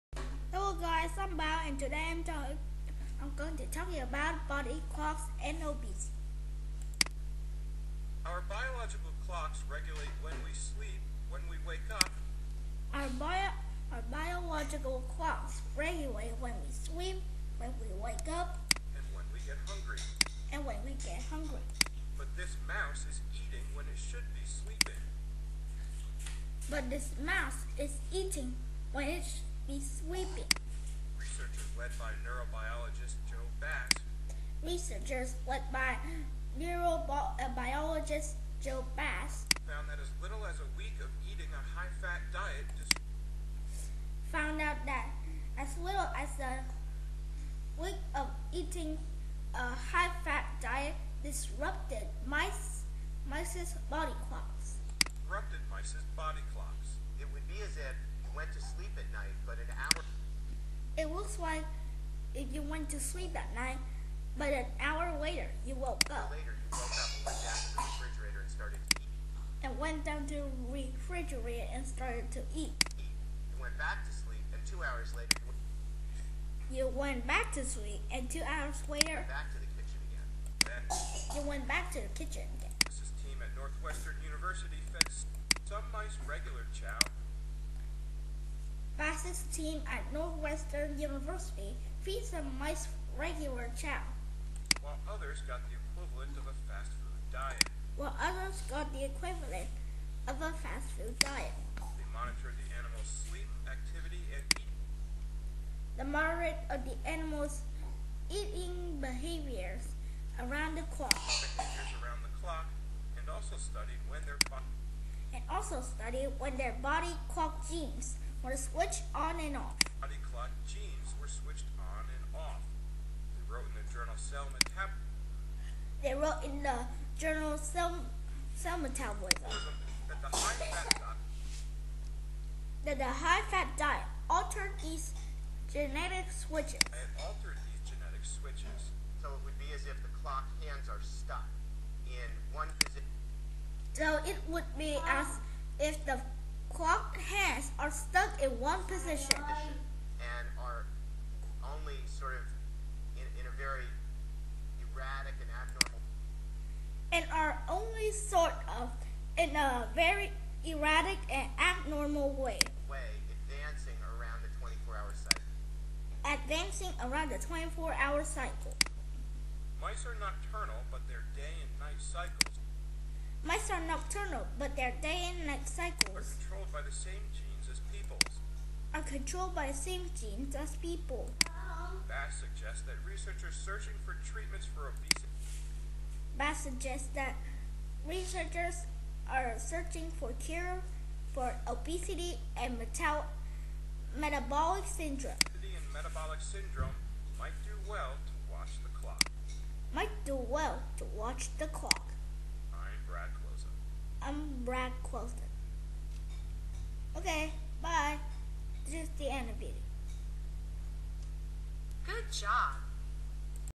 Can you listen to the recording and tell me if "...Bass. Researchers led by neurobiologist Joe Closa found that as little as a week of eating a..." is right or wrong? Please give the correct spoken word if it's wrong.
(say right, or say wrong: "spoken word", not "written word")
wrong: "Bass", not "Closa".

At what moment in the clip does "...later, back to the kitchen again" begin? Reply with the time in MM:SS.
01:18.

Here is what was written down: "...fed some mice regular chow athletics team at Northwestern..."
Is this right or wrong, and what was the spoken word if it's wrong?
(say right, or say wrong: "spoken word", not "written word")
right.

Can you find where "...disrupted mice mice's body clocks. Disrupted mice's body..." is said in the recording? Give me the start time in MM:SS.
00:51.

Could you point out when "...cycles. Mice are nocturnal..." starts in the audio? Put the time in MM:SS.
02:51.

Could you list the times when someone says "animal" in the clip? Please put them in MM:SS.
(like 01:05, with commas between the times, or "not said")
01:42, 01:47.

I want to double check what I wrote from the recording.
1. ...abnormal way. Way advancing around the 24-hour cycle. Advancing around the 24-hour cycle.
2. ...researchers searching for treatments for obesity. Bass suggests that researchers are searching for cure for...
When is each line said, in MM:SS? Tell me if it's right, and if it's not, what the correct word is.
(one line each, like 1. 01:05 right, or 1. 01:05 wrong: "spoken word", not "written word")
1. 02:41 right
2. 03:03 right.